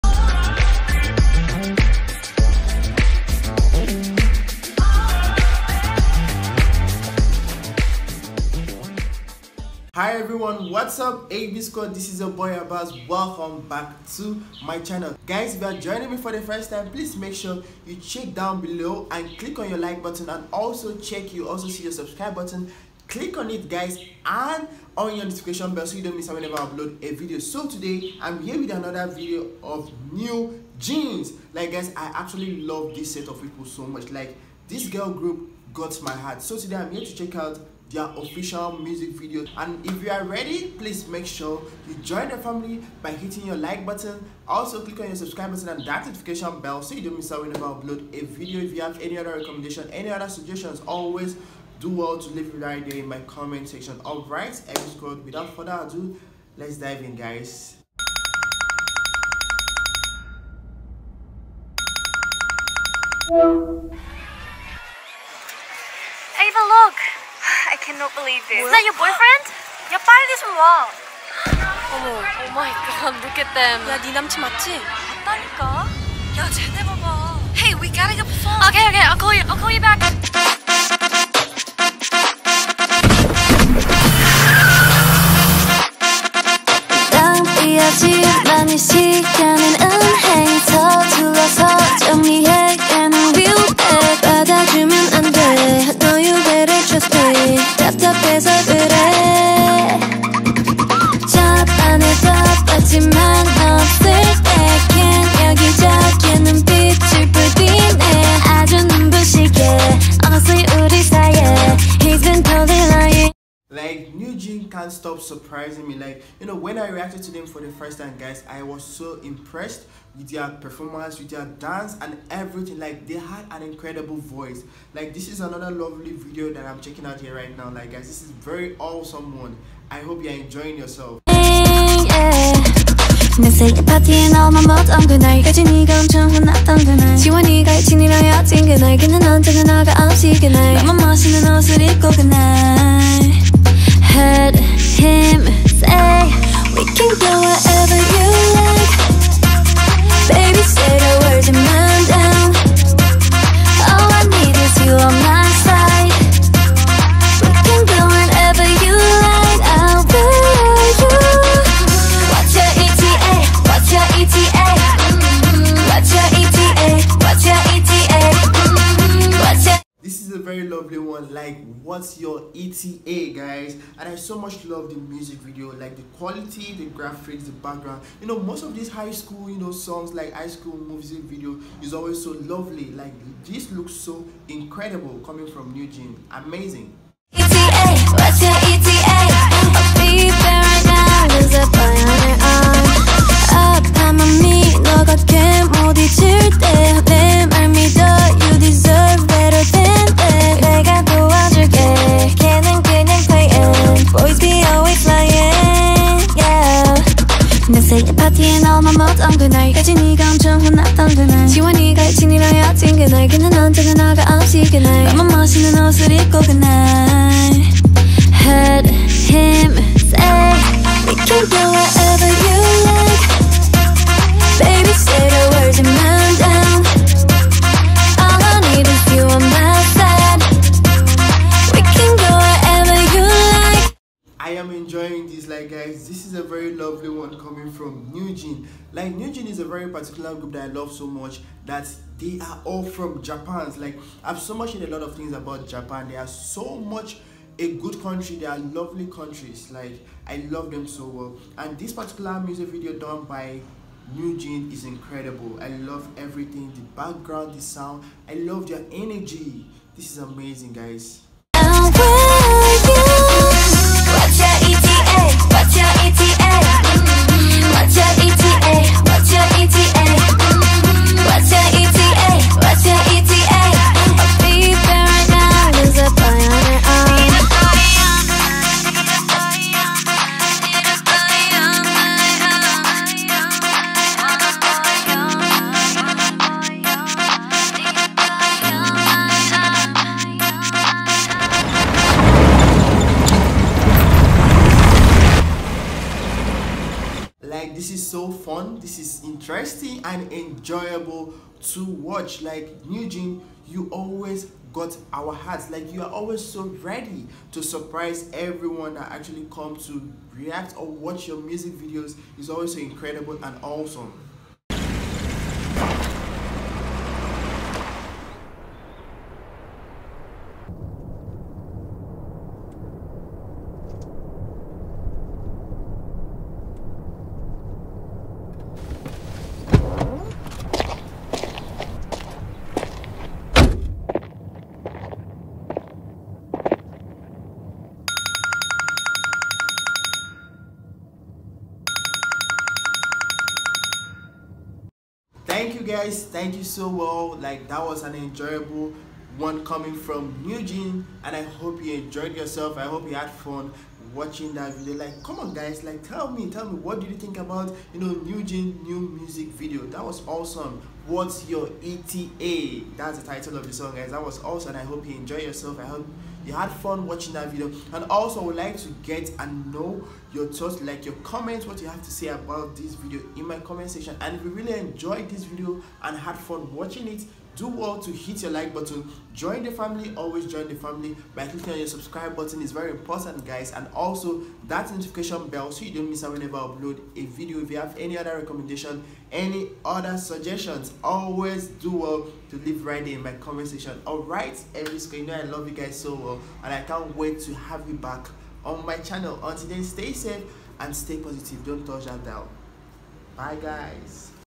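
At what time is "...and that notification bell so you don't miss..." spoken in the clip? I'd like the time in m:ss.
0:45.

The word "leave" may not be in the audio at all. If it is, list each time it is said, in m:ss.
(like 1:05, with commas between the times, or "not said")
0:52, 6:32.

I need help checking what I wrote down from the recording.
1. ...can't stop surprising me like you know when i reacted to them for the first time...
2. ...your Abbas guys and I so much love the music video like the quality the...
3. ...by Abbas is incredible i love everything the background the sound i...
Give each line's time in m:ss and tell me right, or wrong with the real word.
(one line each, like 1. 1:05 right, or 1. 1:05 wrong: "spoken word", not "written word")
1. 1:54 right
2. 2:52 wrong: "ETA", not "Abbas"
3. 4:13 wrong: "NewJeans", not "Abbas".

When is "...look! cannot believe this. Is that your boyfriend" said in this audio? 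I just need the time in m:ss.
1:06.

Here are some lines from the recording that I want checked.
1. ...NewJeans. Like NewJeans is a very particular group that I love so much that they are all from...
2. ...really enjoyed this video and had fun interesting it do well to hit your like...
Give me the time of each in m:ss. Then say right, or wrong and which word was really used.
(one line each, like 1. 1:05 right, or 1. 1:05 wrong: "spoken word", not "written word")
1. 3:58 right
2. 6:14 wrong: "watching", not "interesting".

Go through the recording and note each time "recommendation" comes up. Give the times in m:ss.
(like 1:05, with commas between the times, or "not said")
0:49, 6:28.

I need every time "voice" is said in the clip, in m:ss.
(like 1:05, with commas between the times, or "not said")
2:04.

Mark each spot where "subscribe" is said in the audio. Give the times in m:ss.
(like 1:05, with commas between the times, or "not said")
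0:21, 0:45, 6:21.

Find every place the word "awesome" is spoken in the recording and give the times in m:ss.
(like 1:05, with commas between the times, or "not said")
2:08, 5:13, 6:00, 6:04.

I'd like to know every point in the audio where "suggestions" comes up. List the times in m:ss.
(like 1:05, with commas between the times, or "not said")
0:50, 6:30.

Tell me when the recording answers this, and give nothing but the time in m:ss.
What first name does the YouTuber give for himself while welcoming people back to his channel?
0:12.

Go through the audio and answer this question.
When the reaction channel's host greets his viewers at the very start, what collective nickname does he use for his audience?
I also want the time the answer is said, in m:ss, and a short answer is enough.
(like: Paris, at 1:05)
AB squad, at 0:11.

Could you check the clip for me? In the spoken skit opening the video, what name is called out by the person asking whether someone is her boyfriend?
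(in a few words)
Ava.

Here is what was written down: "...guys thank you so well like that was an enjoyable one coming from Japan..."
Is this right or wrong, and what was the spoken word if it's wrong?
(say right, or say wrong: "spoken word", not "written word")
wrong: "NewJeans", not "Japan".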